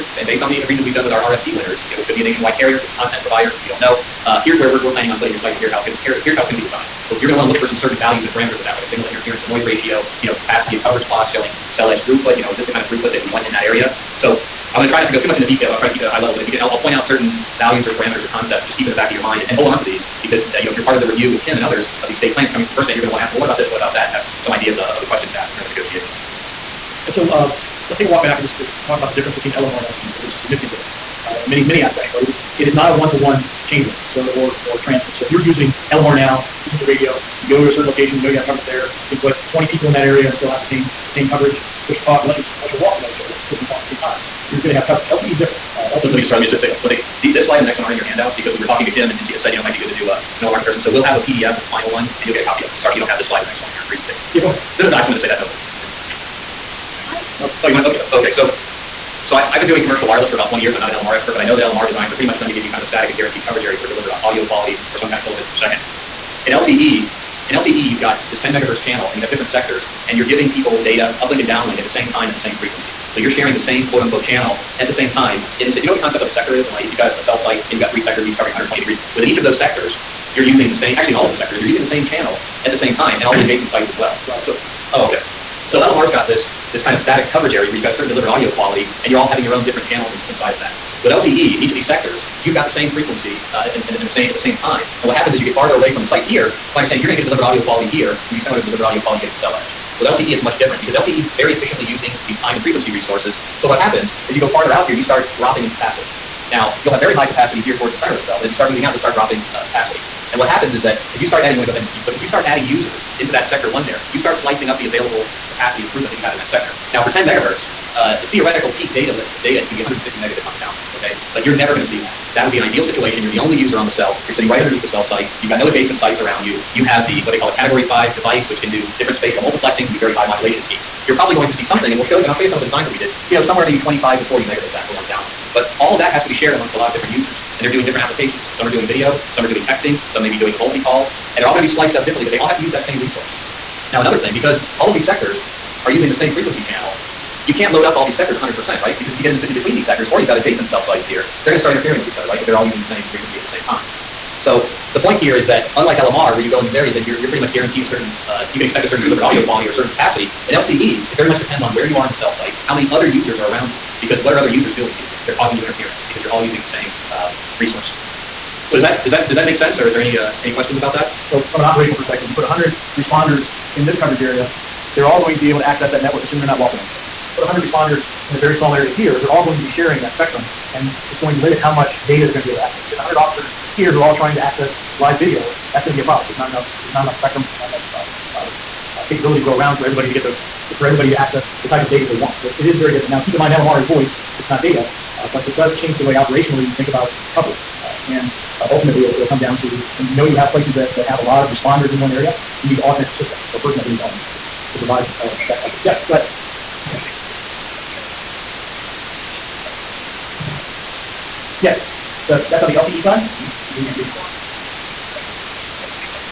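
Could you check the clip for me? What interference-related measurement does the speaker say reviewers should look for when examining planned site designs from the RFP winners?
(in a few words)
signal to interference to noise ratio.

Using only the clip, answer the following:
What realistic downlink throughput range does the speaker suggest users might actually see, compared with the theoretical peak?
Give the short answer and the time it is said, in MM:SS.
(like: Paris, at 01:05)
25 to 40 megabits, at 02:13.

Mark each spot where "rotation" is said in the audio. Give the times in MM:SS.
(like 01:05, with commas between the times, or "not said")
not said.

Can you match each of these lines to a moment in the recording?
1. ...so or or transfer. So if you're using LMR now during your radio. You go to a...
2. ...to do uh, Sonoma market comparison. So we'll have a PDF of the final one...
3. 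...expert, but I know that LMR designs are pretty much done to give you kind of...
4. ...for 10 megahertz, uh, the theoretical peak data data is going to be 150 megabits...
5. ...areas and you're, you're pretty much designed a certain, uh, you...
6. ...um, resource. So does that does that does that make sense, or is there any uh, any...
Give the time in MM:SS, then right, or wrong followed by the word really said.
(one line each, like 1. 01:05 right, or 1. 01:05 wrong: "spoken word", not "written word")
1. 00:34 wrong: "using", not "during"
2. 00:49 right
3. 01:01 right
4. 01:57 right
5. 02:36 wrong: "guaranteed", not "designed"
6. 02:47 right.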